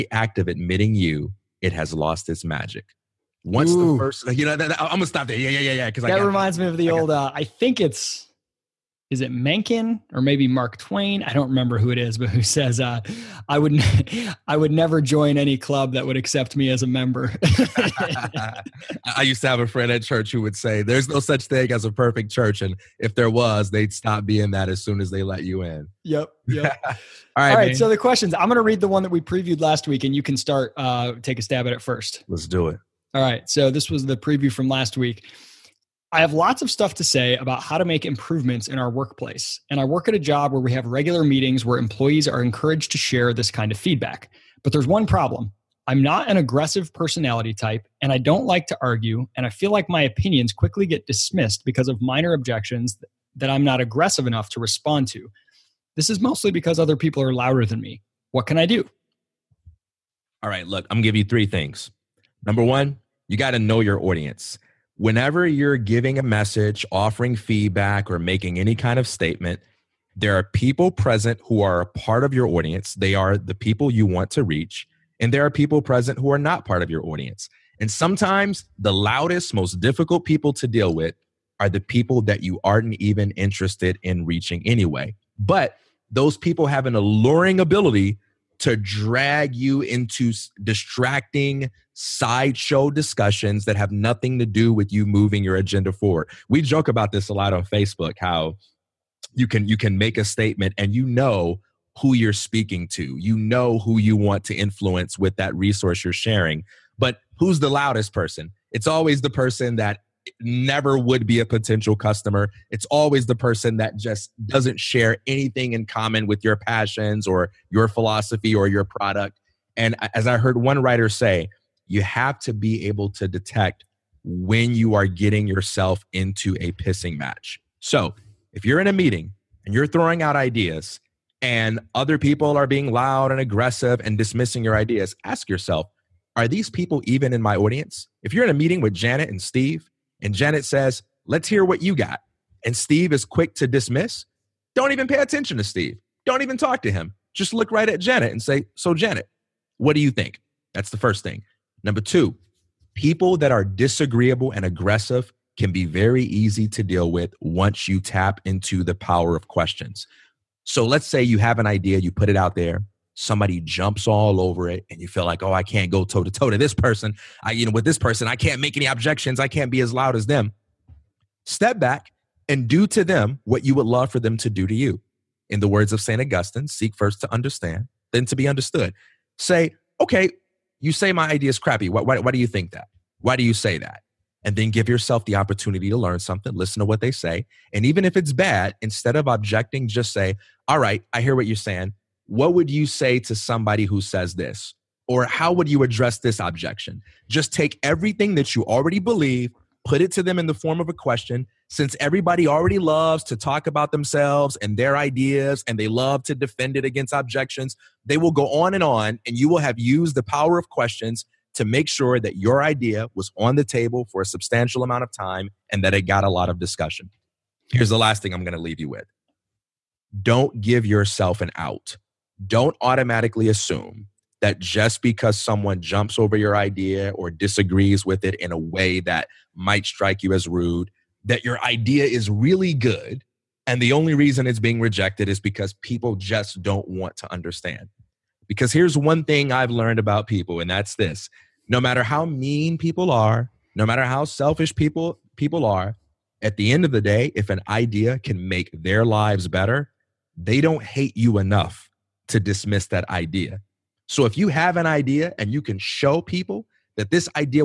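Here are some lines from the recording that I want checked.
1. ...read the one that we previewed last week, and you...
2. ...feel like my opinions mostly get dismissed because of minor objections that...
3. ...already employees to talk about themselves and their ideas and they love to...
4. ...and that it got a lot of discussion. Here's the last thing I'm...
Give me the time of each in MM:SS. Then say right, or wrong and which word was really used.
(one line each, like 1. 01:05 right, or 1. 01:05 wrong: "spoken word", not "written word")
1. 00:28 right
2. 00:49 wrong: "quickly", not "mostly"
3. 03:22 wrong: "loves", not "employees"
4. 03:35 right.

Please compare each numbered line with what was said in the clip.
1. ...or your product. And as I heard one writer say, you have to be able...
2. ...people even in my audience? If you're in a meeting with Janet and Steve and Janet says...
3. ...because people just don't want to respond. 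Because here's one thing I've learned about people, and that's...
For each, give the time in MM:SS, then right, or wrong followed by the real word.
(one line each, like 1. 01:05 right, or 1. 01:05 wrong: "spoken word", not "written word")
1. 01:58 right
2. 02:16 right
3. 03:55 wrong: "understand", not "respond".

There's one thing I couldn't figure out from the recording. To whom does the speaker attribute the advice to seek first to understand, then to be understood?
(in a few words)
St. Augustine.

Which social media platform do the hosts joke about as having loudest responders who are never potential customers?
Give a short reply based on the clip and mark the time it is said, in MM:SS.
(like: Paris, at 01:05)
Facebook, at 01:37.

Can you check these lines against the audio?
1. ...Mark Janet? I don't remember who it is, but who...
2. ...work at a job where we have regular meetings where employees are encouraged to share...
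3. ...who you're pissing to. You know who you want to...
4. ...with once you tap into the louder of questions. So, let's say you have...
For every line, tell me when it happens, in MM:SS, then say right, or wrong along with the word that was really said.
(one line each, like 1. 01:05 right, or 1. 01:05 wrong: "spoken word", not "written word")
1. 00:10 wrong: "Twain", not "Janet"
2. 00:39 right
3. 01:41 wrong: "speaking", not "pissing"
4. 02:37 wrong: "power", not "louder".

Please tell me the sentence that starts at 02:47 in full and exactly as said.
I, you know, with this person, I can't make any objections.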